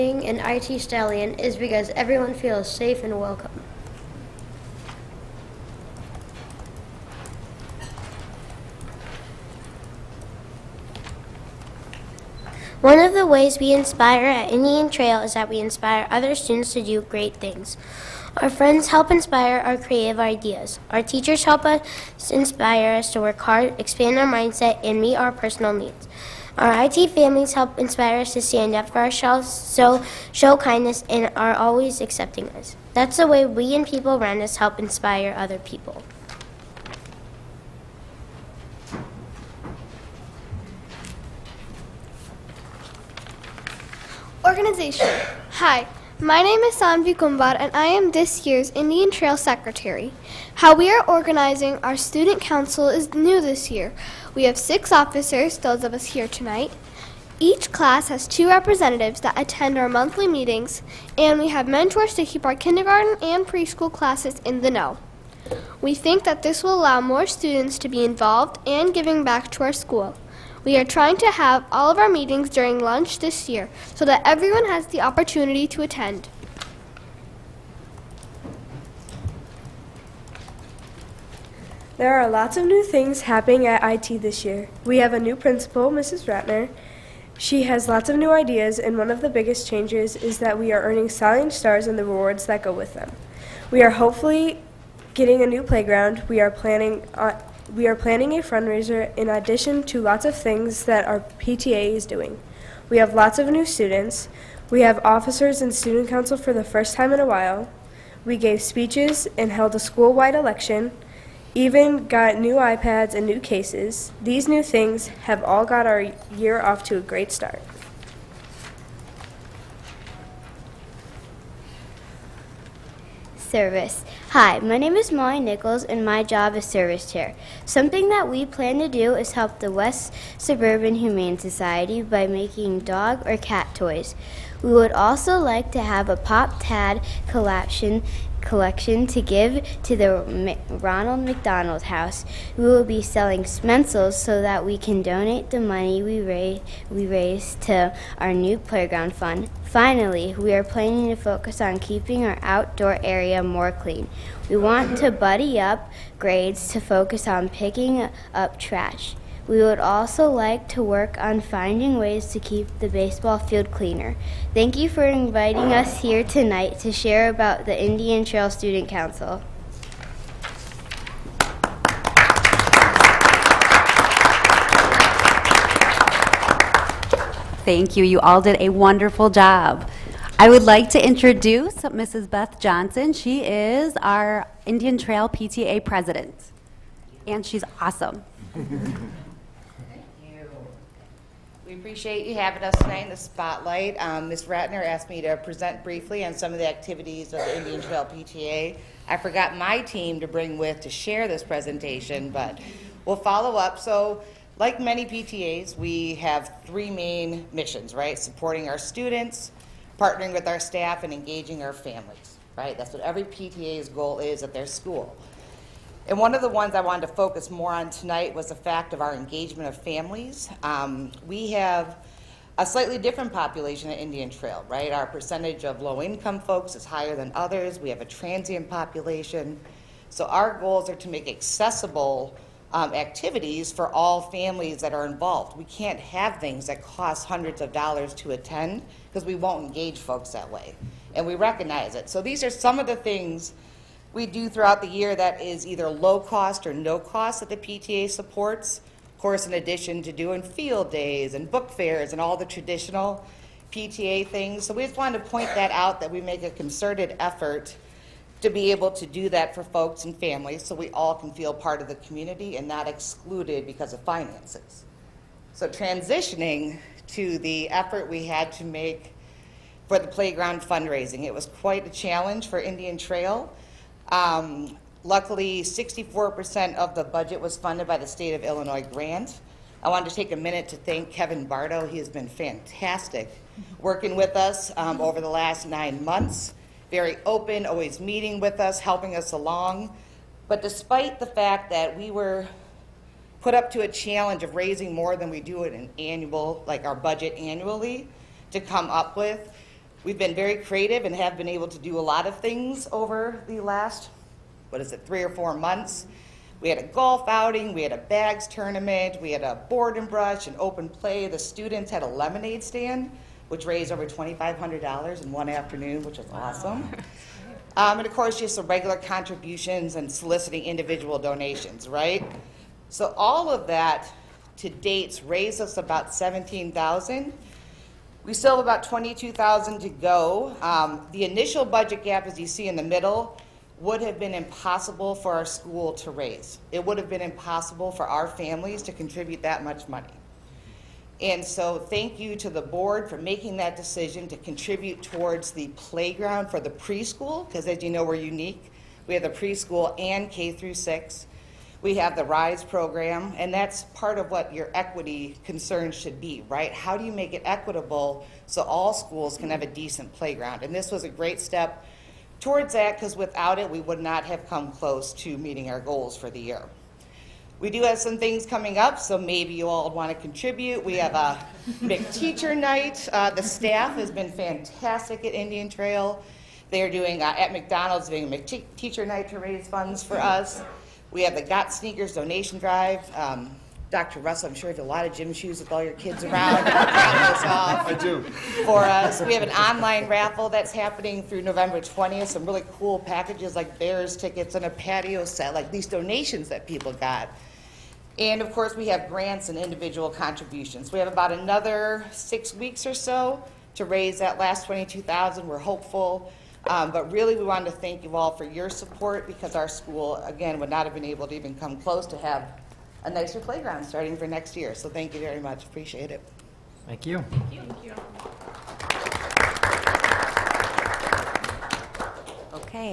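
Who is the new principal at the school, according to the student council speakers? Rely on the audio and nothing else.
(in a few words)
Mrs. Ratner.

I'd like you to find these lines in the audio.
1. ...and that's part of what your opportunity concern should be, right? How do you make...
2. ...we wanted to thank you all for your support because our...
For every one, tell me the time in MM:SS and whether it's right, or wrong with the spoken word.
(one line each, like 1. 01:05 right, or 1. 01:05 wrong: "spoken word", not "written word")
1. 05:53 wrong: "equity", not "opportunity"
2. 06:47 right.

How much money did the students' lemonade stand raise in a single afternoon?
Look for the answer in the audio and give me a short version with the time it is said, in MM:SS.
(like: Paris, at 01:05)
$2,500, at 05:14.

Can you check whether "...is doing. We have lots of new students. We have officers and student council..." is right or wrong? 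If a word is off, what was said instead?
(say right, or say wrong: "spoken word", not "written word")
right.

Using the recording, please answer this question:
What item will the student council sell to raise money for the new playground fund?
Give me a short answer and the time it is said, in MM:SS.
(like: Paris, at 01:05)
Smencils, at 02:23.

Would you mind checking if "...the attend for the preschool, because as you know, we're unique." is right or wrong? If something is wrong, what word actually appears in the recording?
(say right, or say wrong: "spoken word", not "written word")
wrong: "playground", not "attend".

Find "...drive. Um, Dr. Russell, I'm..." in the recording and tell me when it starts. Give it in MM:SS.
06:22.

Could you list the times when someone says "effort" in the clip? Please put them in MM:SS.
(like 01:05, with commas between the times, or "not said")
04:17, 04:27.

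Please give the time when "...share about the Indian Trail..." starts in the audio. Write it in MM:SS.
02:46.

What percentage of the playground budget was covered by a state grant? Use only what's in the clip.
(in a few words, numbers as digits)
64%.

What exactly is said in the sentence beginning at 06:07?
We do have some things coming up, so maybe you all want to contribute.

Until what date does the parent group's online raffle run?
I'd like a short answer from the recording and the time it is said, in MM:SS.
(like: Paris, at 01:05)
November 20th, at 06:31.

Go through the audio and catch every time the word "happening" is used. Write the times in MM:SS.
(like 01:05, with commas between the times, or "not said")
01:23, 06:30.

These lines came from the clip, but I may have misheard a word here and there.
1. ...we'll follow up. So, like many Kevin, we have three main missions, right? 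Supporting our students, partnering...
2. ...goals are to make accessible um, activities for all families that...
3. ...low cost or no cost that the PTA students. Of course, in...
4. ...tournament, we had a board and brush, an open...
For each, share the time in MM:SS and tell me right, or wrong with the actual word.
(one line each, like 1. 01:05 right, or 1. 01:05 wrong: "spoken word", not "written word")
1. 03:23 wrong: "PTAs", not "Kevin"
2. 03:50 right
3. 04:05 wrong: "supports", not "students"
4. 05:08 right.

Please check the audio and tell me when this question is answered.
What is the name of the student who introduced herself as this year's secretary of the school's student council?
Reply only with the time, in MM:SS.
00:46.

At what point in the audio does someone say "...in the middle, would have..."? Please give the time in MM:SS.
05:32.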